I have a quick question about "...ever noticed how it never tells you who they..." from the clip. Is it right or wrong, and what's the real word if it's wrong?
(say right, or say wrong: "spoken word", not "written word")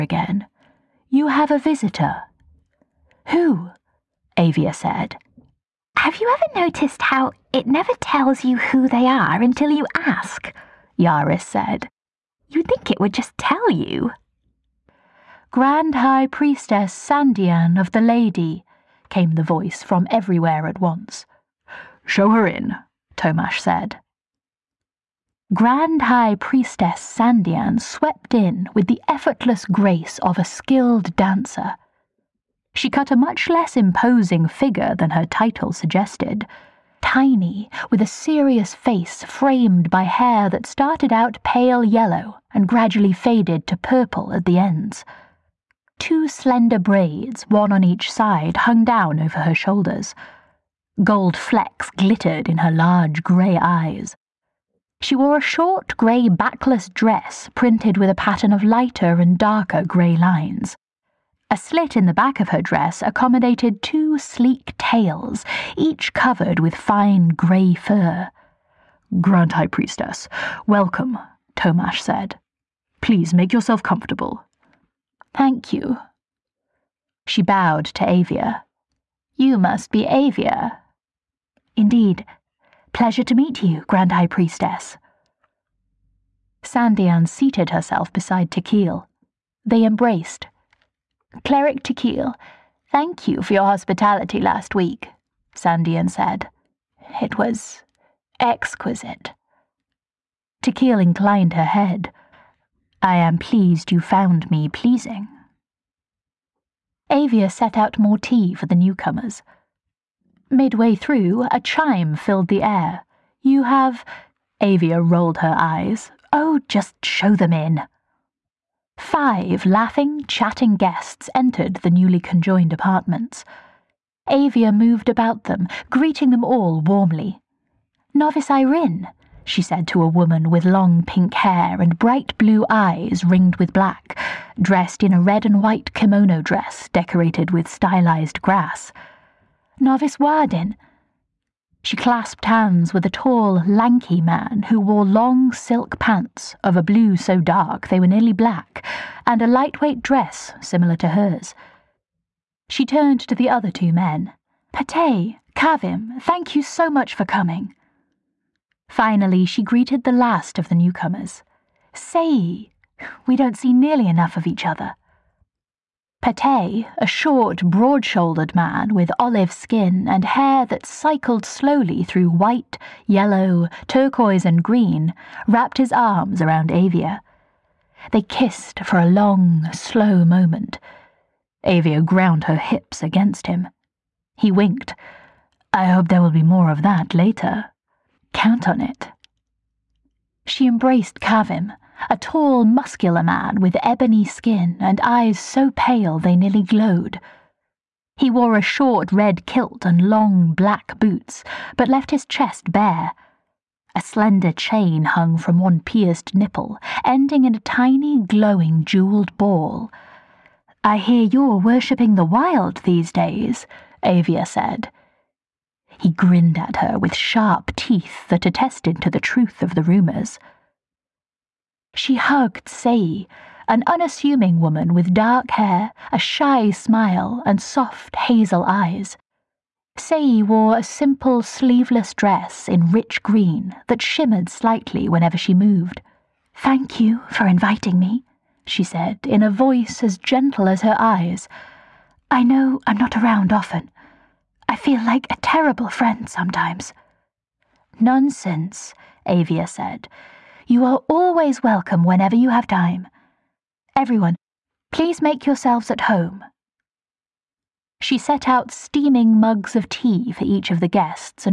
right.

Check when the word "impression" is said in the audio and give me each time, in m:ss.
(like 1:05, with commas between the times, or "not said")
not said.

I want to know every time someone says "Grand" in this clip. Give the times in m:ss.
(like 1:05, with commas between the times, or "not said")
0:15, 0:25, 1:09, 1:23.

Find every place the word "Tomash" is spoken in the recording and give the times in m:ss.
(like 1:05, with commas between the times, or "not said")
0:23, 1:11.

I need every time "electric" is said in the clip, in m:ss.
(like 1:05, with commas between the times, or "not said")
not said.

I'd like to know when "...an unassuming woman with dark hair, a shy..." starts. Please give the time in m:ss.
3:43.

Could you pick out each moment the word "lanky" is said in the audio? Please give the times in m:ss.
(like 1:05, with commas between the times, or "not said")
2:23.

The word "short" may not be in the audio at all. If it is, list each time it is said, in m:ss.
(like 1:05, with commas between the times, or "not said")
0:55, 2:47, 3:18.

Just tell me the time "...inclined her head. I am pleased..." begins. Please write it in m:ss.
1:41.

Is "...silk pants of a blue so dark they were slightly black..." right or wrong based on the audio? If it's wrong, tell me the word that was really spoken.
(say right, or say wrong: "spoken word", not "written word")
wrong: "nearly", not "slightly".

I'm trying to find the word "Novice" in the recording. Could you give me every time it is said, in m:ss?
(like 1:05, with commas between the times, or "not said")
2:08, 2:19.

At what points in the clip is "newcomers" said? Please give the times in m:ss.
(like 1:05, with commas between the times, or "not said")
1:48, 2:40.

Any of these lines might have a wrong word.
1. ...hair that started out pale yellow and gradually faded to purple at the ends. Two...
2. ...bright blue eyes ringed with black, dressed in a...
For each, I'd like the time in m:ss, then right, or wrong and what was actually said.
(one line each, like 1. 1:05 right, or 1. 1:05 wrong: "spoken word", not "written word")
1. 0:40 right
2. 2:11 right.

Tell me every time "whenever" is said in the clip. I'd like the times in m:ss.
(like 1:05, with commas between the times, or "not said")
3:55, 4:12.